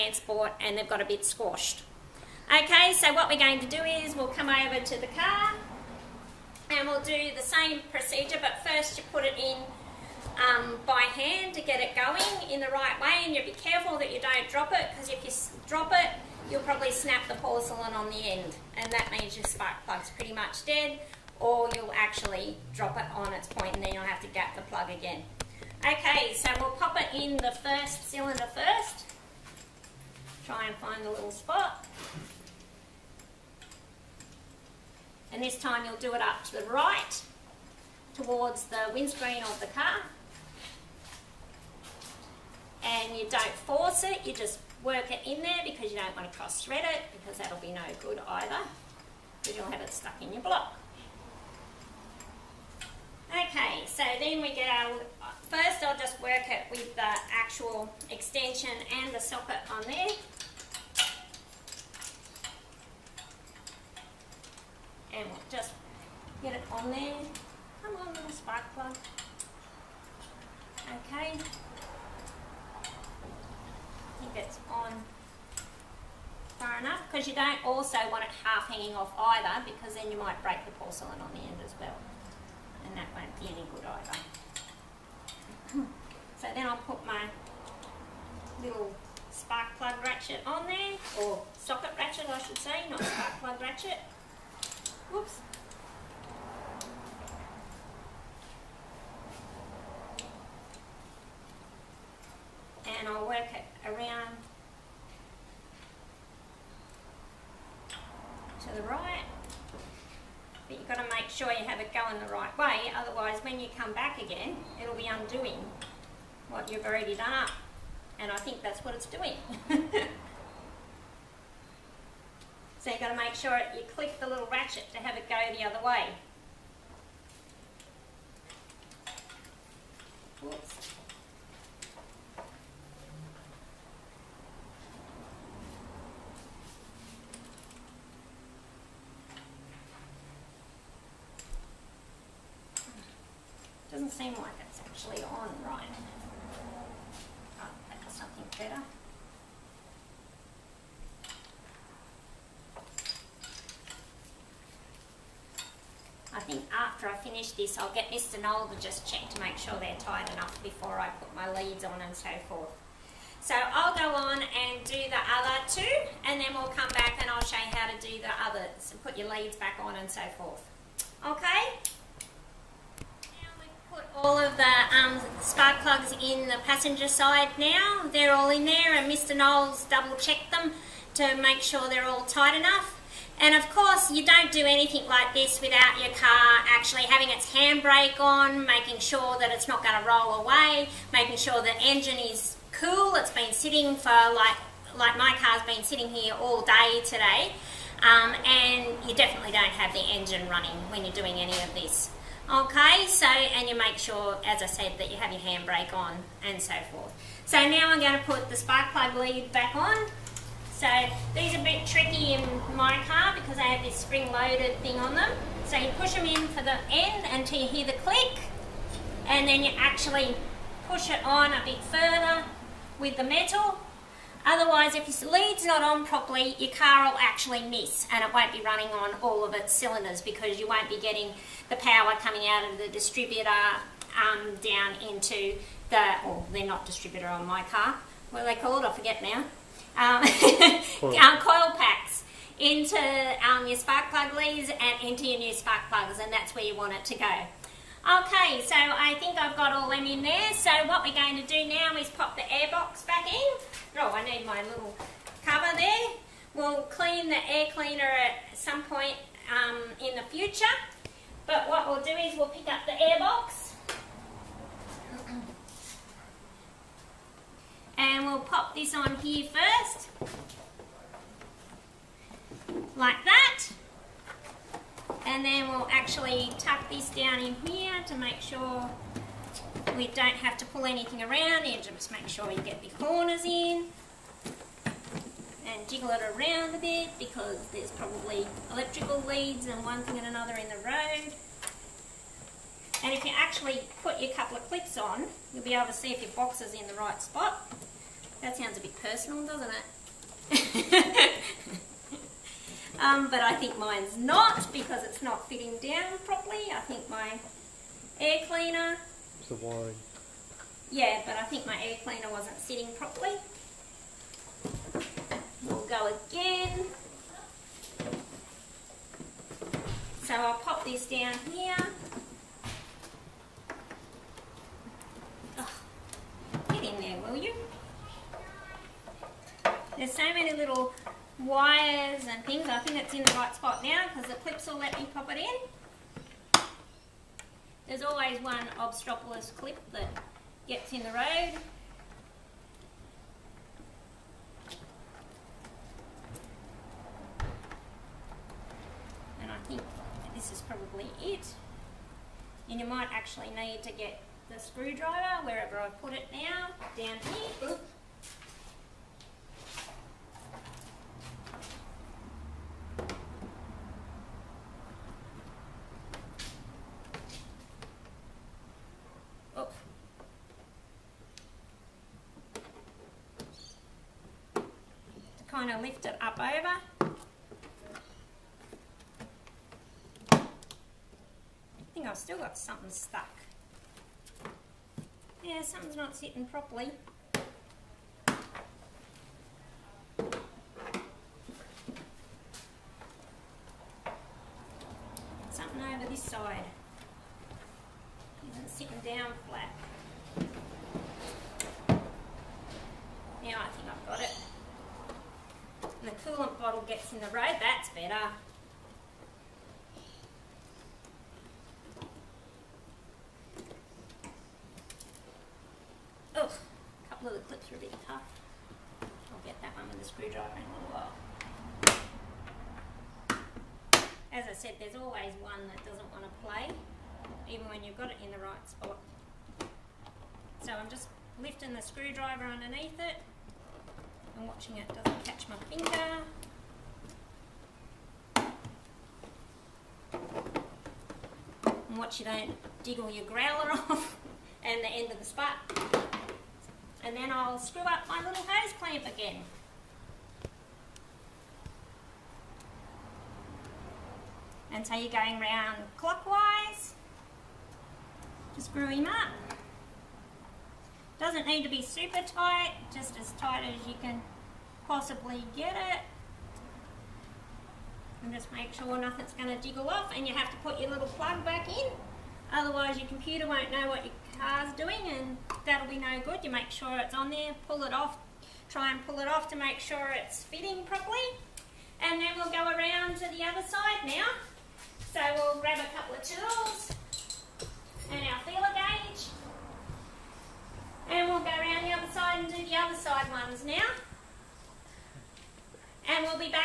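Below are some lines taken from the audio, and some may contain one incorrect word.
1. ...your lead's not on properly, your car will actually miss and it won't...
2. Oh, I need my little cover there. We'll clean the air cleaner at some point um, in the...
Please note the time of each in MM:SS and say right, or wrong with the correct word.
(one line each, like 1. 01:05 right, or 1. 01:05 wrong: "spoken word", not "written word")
1. 03:45 right
2. 04:13 right.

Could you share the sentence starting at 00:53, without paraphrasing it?
Okay, so then we get our, first I'll just work it with the actual extension and the socket on there.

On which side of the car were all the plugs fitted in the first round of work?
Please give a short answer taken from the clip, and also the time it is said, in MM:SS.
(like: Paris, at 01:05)
Passenger side, at 02:56.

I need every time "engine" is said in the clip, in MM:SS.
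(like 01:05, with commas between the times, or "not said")
03:11, 03:20.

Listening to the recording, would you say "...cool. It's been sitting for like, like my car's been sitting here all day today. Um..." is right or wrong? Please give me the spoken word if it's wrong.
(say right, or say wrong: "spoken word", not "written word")
right.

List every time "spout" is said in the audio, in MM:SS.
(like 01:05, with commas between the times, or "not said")
07:25.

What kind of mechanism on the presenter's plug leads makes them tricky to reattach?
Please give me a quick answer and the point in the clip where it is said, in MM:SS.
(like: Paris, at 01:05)
Spring loaded, at 03:33.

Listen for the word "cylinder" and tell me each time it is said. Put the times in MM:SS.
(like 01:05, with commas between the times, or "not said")
00:28, 03:49.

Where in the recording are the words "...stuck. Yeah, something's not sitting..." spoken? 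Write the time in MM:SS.
06:22.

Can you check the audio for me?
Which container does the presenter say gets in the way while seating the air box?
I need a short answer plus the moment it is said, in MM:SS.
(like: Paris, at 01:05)
The coolant bottle, at 06:46.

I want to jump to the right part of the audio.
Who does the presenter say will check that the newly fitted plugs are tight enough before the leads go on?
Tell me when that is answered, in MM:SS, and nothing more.
02:38.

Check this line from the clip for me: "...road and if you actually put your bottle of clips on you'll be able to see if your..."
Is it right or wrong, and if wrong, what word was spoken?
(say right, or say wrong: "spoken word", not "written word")
wrong: "couple", not "bottle".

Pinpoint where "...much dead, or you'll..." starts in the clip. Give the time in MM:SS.
00:20.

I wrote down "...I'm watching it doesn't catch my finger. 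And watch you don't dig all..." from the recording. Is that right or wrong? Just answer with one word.
right.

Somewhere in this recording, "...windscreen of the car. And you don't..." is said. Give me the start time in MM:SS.
00:38.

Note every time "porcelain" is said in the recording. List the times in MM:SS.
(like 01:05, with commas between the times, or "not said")
00:17, 01:20.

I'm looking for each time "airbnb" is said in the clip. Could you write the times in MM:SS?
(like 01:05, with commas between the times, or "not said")
not said.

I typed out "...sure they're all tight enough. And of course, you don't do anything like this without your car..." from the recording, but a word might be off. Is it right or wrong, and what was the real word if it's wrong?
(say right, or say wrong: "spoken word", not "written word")
right.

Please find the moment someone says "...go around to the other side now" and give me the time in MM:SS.
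08:02.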